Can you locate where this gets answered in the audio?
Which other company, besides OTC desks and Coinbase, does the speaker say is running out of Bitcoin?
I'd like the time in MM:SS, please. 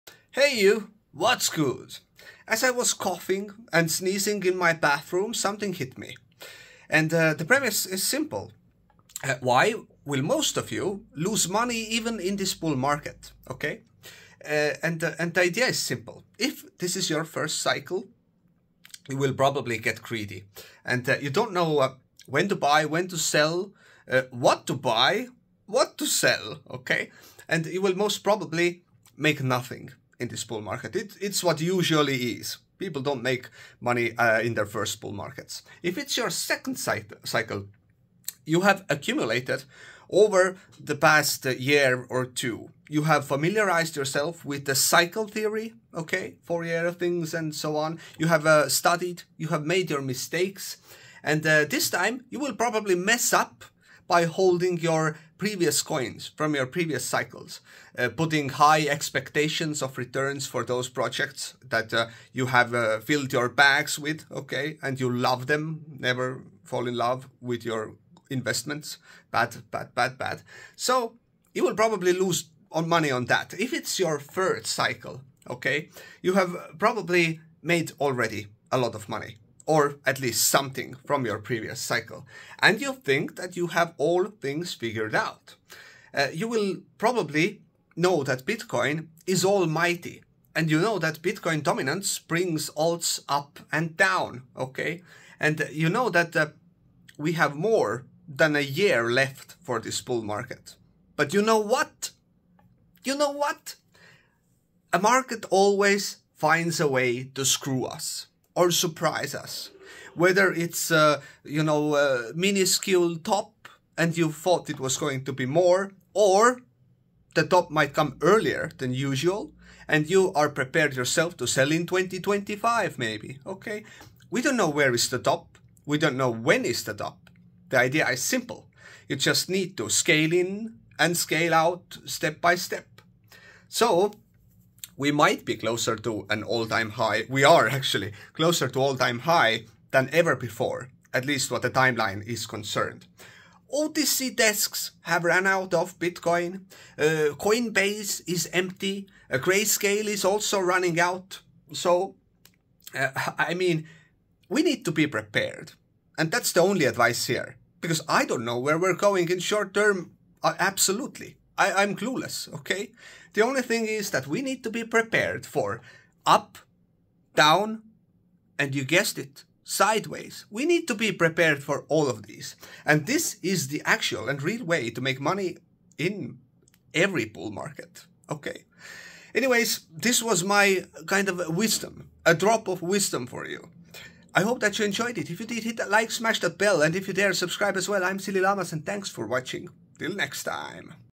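02:29.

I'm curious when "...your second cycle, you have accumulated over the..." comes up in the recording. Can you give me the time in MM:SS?
00:36.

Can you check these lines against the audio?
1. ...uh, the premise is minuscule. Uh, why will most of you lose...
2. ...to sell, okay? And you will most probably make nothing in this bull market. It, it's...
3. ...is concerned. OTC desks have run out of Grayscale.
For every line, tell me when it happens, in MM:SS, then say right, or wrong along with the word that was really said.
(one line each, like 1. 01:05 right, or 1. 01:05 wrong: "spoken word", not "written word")
1. 00:07 wrong: "simple", not "minuscule"
2. 00:25 right
3. 02:22 wrong: "Bitcoin", not "Grayscale".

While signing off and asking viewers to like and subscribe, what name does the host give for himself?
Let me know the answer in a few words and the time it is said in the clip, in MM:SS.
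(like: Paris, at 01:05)
SillyLlamaz, at 03:08.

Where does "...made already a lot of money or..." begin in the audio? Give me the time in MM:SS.
01:17.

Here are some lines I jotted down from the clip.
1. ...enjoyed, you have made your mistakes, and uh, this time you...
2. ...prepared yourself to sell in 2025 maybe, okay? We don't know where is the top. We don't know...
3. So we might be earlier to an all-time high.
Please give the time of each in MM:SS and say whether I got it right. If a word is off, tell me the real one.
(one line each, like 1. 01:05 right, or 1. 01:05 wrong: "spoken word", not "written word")
1. 00:48 wrong: "studied", not "enjoyed"
2. 02:00 right
3. 02:13 wrong: "closer", not "earlier".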